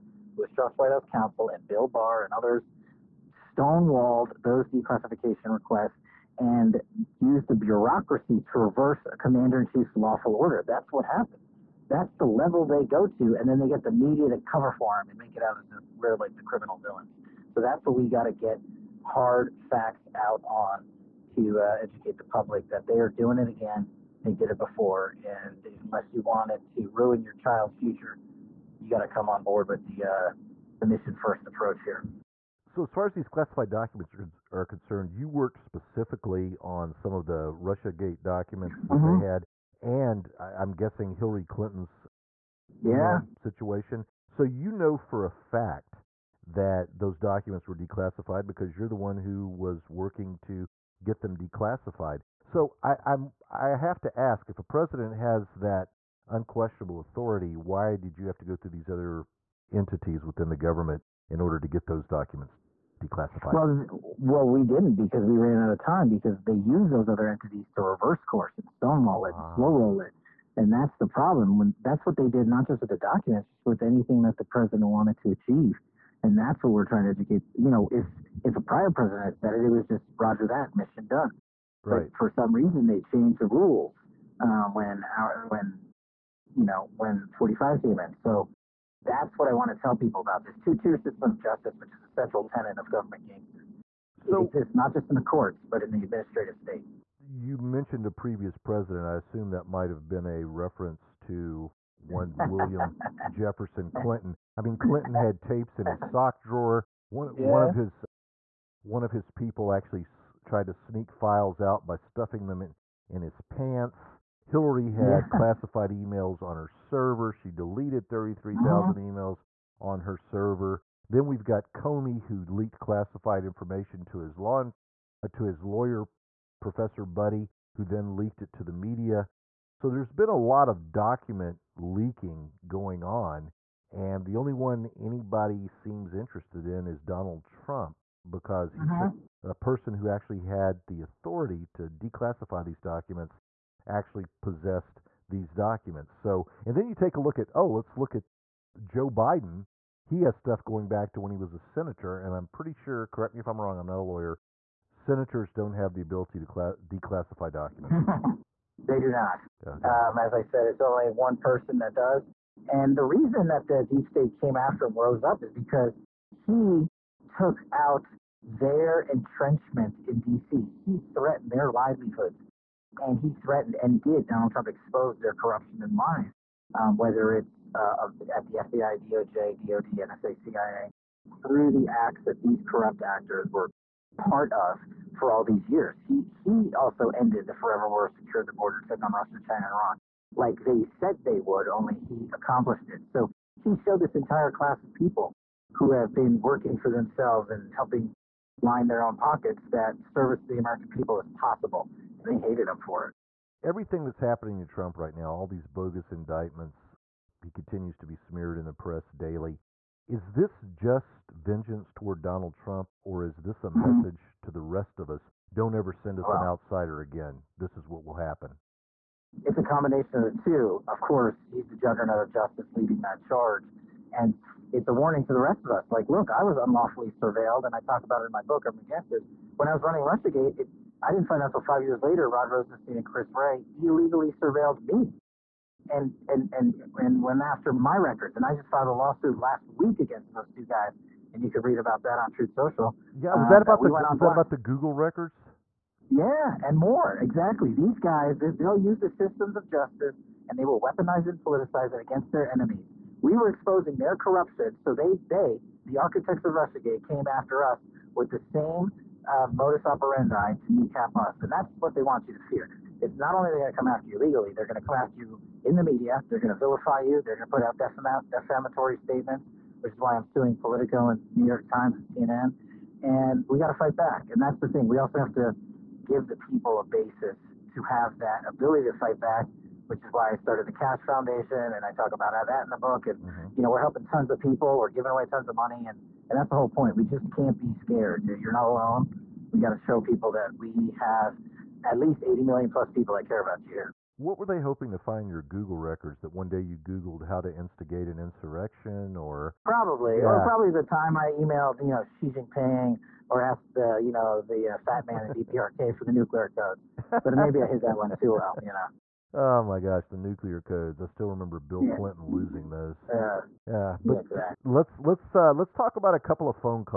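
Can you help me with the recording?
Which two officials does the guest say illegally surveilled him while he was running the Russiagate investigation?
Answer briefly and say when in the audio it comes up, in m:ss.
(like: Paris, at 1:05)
Rod Rosenstein and Chris Wray, at 3:52.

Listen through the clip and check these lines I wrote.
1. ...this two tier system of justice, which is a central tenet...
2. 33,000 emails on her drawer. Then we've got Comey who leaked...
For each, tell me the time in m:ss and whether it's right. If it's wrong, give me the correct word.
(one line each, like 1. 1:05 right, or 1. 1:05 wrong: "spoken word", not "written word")
1. 1:30 right
2. 1:58 wrong: "server", not "drawer".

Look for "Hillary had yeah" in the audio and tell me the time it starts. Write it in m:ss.
1:54.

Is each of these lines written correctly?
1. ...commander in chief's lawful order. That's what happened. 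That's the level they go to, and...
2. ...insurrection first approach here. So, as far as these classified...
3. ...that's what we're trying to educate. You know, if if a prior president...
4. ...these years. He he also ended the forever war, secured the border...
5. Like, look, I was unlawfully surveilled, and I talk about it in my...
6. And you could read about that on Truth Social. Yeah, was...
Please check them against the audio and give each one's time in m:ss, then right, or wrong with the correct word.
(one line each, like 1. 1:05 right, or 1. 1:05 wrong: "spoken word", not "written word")
1. 0:09 right
2. 0:30 wrong: "mission", not "insurrection"
3. 1:16 right
4. 3:05 right
5. 3:45 right
6. 4:01 right.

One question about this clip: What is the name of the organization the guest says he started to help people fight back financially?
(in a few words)
Kash Foundation.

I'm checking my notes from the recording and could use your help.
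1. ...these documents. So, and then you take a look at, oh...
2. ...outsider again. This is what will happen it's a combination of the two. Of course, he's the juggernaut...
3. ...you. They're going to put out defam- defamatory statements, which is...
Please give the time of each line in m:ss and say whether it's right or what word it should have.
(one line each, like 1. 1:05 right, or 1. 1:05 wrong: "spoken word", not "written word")
1. 2:25 right
2. 3:36 right
3. 4:26 right.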